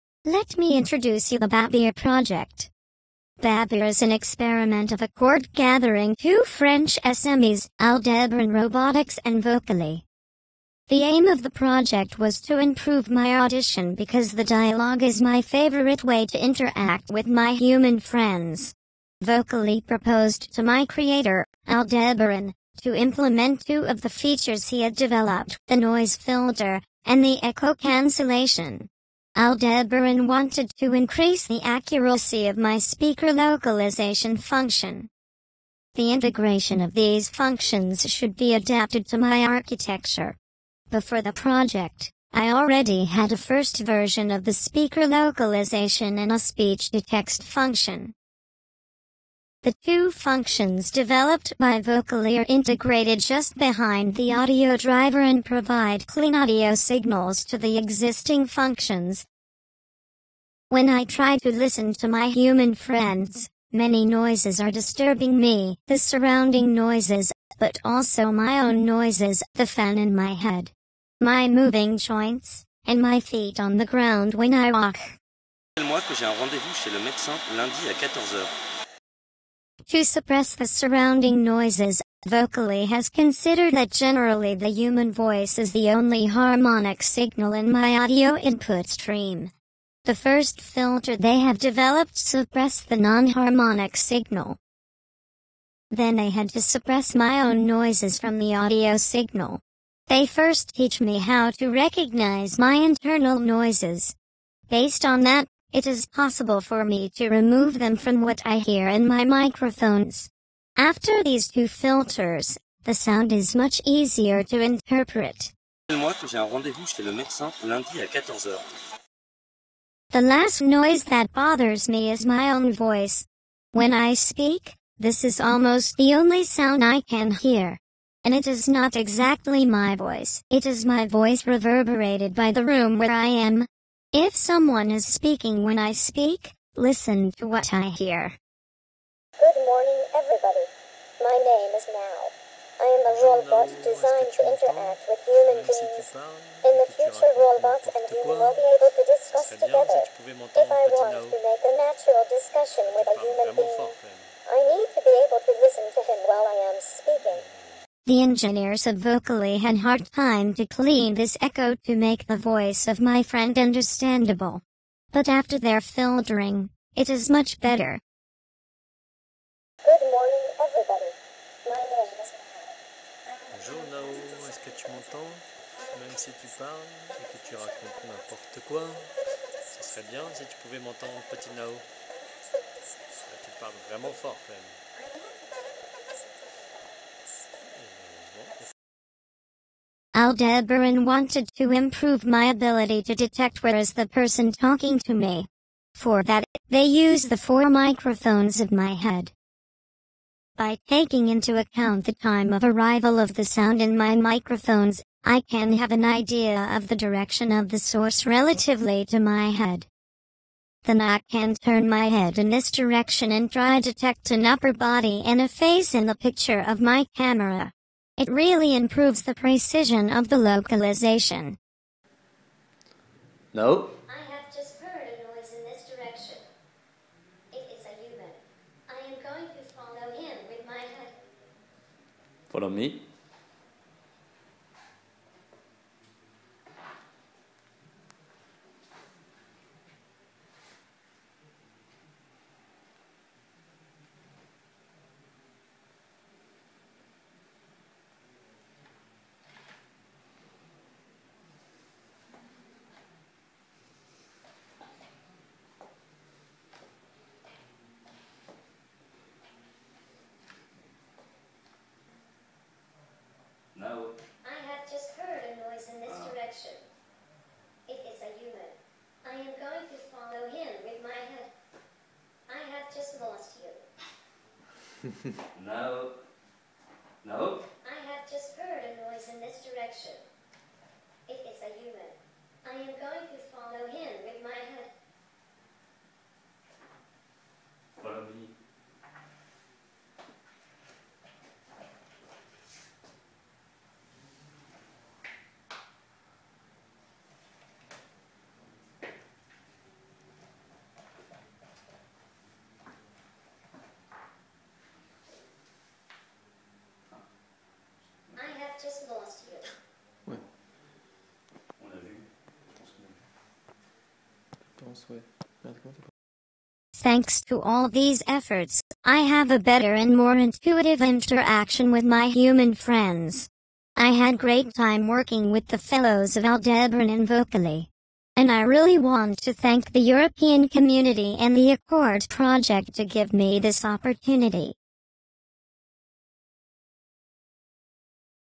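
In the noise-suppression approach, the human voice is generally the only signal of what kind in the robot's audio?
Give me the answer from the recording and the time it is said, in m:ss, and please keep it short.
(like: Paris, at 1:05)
harmonic signal, at 1:26.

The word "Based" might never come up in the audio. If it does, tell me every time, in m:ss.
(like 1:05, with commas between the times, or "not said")
1:44.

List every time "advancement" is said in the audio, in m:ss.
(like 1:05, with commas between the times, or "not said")
not said.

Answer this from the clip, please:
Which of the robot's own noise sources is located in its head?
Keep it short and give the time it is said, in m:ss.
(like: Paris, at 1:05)
the fan, at 1:09.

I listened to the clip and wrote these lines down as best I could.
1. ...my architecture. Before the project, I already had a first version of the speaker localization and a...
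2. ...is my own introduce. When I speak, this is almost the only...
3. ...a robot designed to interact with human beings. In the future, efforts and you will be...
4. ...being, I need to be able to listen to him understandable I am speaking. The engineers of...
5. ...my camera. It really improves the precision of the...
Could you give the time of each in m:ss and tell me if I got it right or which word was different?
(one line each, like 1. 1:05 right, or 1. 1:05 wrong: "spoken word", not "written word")
1. 0:39 right
2. 2:02 wrong: "voice", not "introduce"
3. 2:23 wrong: "robots", not "efforts"
4. 2:33 wrong: "while", not "understandable"
5. 3:36 right.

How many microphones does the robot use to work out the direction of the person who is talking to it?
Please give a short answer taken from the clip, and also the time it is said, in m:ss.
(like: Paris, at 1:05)
4, at 3:17.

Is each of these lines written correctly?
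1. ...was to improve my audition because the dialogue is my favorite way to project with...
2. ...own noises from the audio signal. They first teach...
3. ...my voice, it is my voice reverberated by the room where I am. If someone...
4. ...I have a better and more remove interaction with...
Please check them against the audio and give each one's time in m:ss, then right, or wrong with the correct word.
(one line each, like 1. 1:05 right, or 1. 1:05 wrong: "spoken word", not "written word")
1. 0:12 wrong: "interact", not "project"
2. 1:37 right
3. 2:09 right
4. 5:19 wrong: "intuitive", not "remove".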